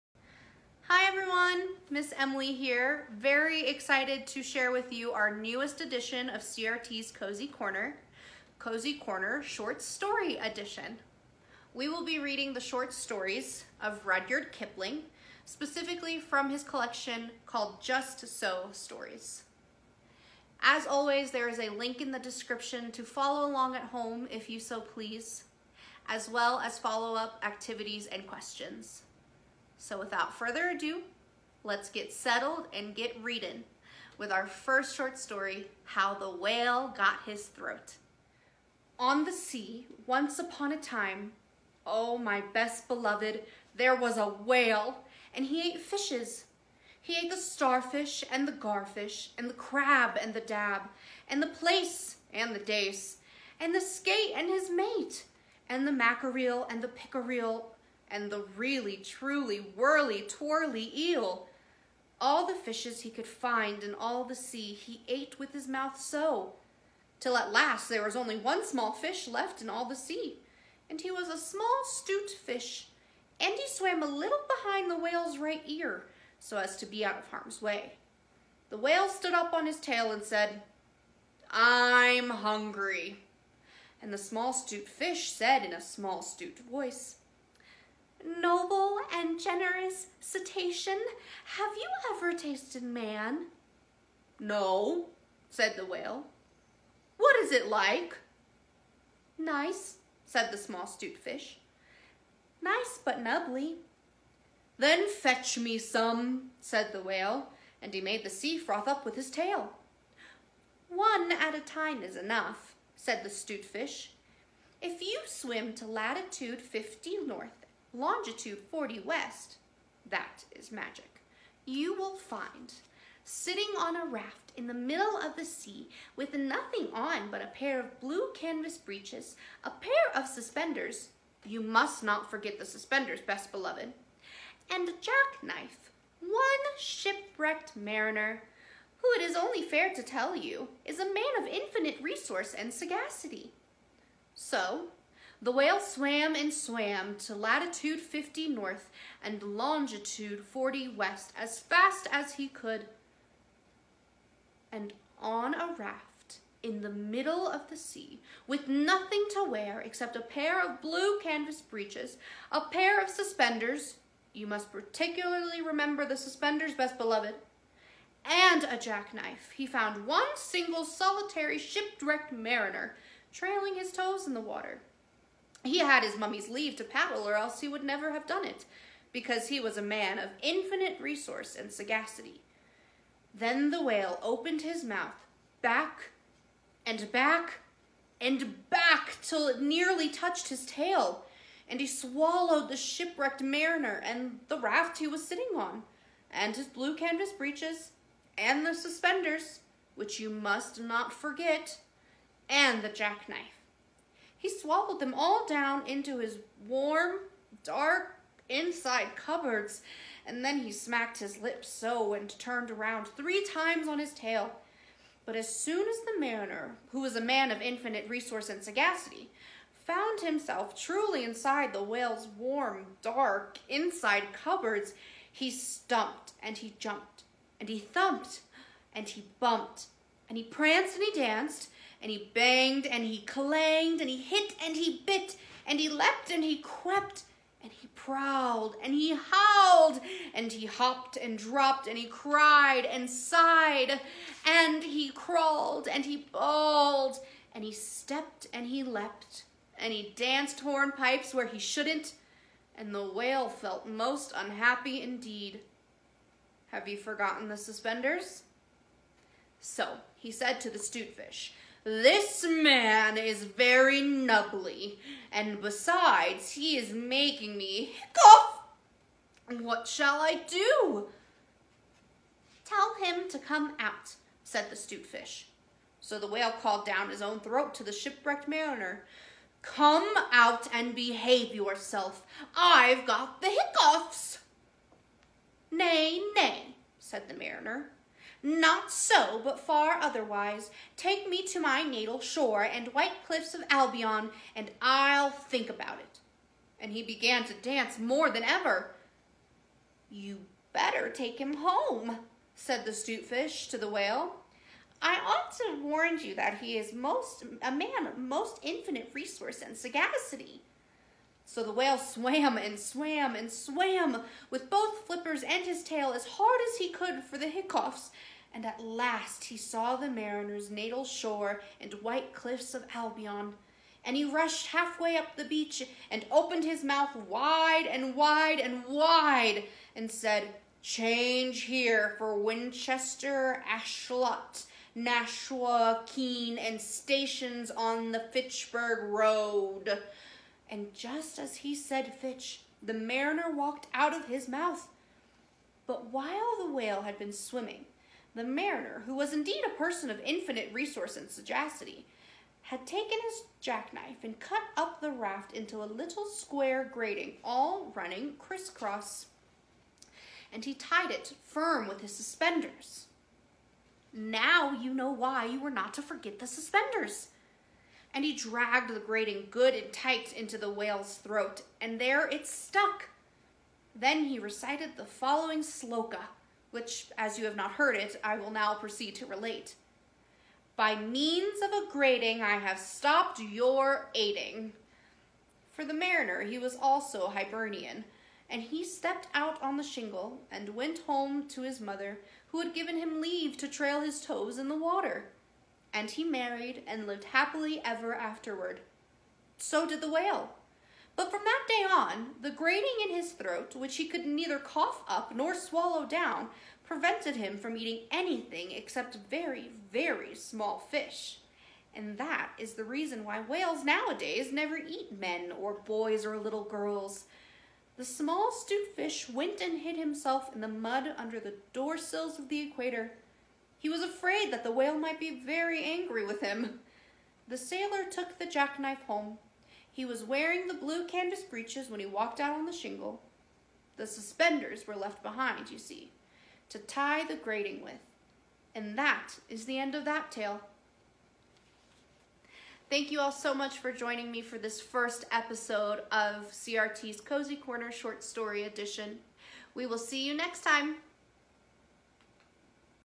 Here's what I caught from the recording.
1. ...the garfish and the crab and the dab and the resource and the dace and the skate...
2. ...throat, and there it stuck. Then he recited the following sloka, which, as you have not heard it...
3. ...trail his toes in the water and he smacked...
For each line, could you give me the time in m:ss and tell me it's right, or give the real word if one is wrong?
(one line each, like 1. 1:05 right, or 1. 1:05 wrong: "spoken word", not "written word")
1. 0:48 wrong: "plaice", not "resource"
2. 6:11 right
3. 6:33 wrong: "married", not "smacked".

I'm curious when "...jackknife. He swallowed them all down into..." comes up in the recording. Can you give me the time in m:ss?
3:22.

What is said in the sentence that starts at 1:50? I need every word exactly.
One at a time is enough, said the stute fish.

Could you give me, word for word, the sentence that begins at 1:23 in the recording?
And the small stute fish said in a small stute voice, noble and generous cetacean, have you ever tasted man?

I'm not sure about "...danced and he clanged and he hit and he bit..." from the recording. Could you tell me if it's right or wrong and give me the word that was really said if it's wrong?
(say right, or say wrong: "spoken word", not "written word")
wrong: "banged", not "danced".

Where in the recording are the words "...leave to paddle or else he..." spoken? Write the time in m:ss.
2:56.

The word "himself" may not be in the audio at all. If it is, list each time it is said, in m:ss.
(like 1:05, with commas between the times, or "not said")
3:40, 6:59.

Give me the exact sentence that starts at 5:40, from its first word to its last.
And just as he said Fitch, the mariner walked out of his mouth.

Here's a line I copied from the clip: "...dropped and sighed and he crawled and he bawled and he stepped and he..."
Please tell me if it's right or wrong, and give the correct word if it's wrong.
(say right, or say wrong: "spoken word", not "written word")
wrong: "cried", not "dropped".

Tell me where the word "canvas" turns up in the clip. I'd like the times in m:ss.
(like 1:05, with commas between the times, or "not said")
2:08, 2:41, 3:16, 7:11.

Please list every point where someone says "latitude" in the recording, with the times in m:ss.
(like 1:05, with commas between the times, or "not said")
1:55, 2:27.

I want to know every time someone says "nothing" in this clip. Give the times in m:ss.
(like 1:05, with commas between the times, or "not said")
2:06, 2:38.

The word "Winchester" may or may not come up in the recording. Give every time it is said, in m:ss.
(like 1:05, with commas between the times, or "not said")
5:32.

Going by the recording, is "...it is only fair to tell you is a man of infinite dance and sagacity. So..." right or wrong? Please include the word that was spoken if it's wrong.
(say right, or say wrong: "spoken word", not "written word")
wrong: "resource", not "dance".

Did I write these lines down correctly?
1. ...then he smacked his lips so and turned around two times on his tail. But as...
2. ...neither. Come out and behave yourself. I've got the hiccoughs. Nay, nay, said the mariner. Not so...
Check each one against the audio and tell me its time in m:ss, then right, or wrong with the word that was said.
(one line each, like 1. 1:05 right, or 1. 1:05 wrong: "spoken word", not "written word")
1. 3:30 wrong: "three", not "two"
2. 4:38 wrong: "mariner", not "neither".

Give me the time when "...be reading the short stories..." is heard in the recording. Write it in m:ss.
0:12.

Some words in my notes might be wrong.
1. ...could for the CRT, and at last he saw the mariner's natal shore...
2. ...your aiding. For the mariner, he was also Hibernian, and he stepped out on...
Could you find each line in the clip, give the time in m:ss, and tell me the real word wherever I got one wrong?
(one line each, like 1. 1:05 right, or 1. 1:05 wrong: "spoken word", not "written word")
1. 5:16 wrong: "Hiccoughs", not "CRT"
2. 6:23 right.